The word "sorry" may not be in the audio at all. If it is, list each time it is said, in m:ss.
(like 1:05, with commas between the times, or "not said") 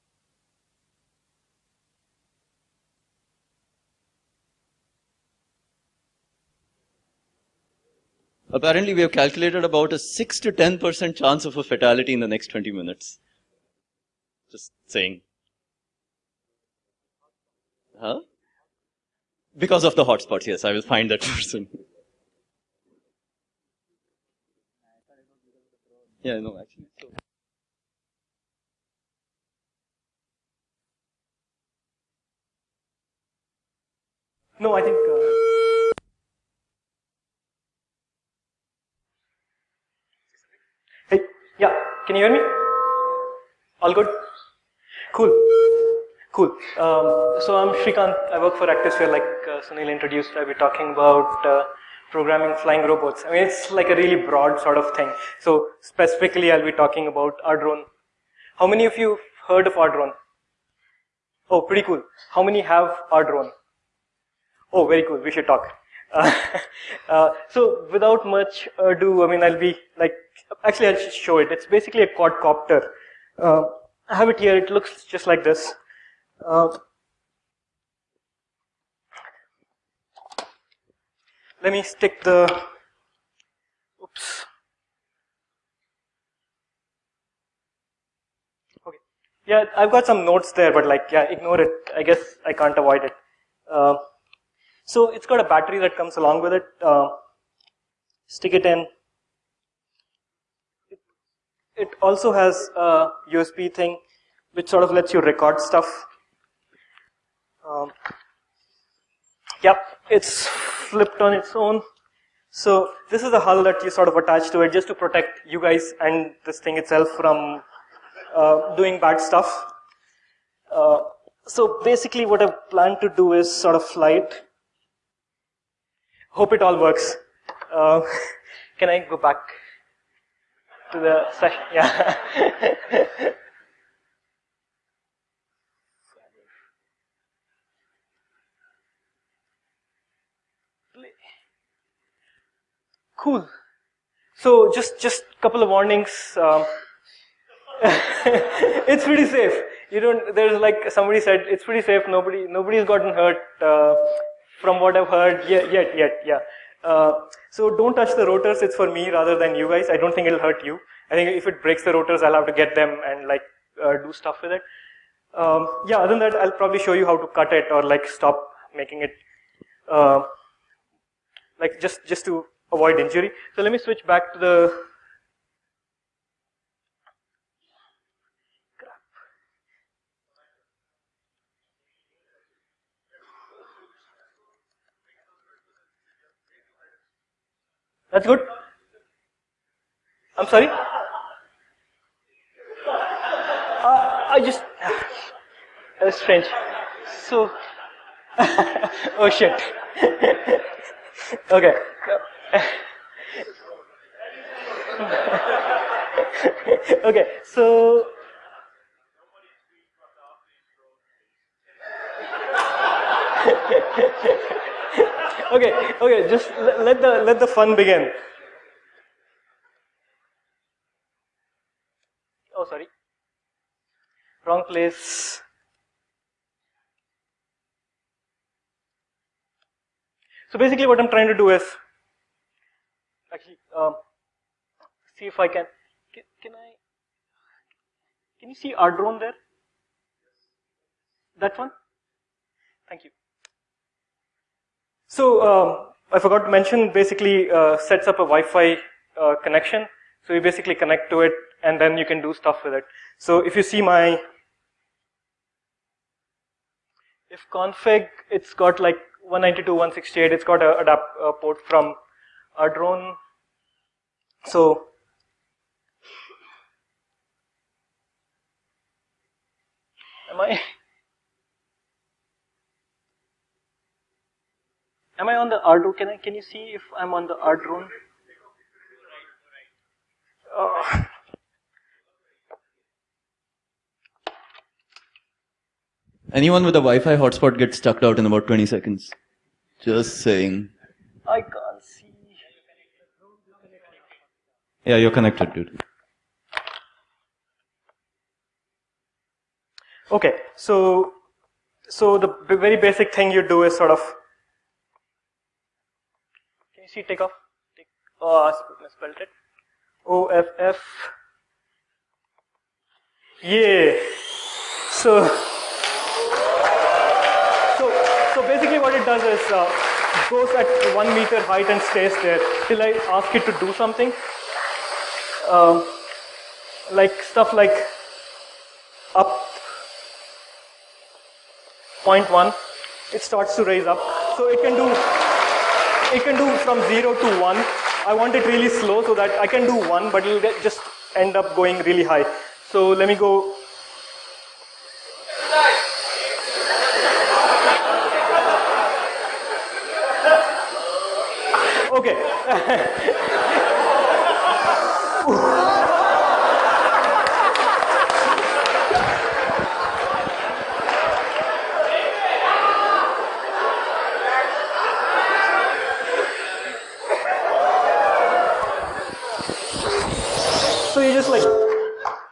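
3:10, 3:42.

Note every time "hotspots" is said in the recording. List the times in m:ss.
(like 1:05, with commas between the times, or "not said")
0:20, 4:47.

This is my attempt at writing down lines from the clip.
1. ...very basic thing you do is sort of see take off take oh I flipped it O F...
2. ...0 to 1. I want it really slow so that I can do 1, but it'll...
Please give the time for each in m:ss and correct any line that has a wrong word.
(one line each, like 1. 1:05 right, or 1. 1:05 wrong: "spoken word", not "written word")
1. 5:02 wrong: "spelled", not "flipped"
2. 5:36 right.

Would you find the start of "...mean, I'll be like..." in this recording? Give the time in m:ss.
1:09.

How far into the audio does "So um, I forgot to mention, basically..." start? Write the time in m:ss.
4:05.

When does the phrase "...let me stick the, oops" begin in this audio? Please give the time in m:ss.
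1:21.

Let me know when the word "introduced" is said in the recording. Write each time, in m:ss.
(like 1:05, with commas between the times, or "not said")
0:49.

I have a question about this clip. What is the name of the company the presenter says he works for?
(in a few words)
ActiveSphere.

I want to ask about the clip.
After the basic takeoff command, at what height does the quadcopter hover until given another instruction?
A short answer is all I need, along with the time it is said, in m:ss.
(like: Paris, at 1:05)
1 meter, at 5:20.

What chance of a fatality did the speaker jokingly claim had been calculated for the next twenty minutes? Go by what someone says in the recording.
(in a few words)
6 to 10%.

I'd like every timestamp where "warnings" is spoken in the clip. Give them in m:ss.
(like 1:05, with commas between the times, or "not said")
2:25.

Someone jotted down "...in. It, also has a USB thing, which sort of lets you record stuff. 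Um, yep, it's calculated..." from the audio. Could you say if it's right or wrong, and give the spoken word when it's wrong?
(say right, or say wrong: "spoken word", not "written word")
wrong: "flipped", not "calculated".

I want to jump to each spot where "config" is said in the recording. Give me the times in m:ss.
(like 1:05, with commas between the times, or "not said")
4:17.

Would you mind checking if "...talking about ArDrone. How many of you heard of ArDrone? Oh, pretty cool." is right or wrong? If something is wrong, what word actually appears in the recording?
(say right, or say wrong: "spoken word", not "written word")
right.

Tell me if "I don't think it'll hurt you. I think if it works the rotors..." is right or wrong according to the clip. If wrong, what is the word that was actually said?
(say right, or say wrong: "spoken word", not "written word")
wrong: "breaks", not "works".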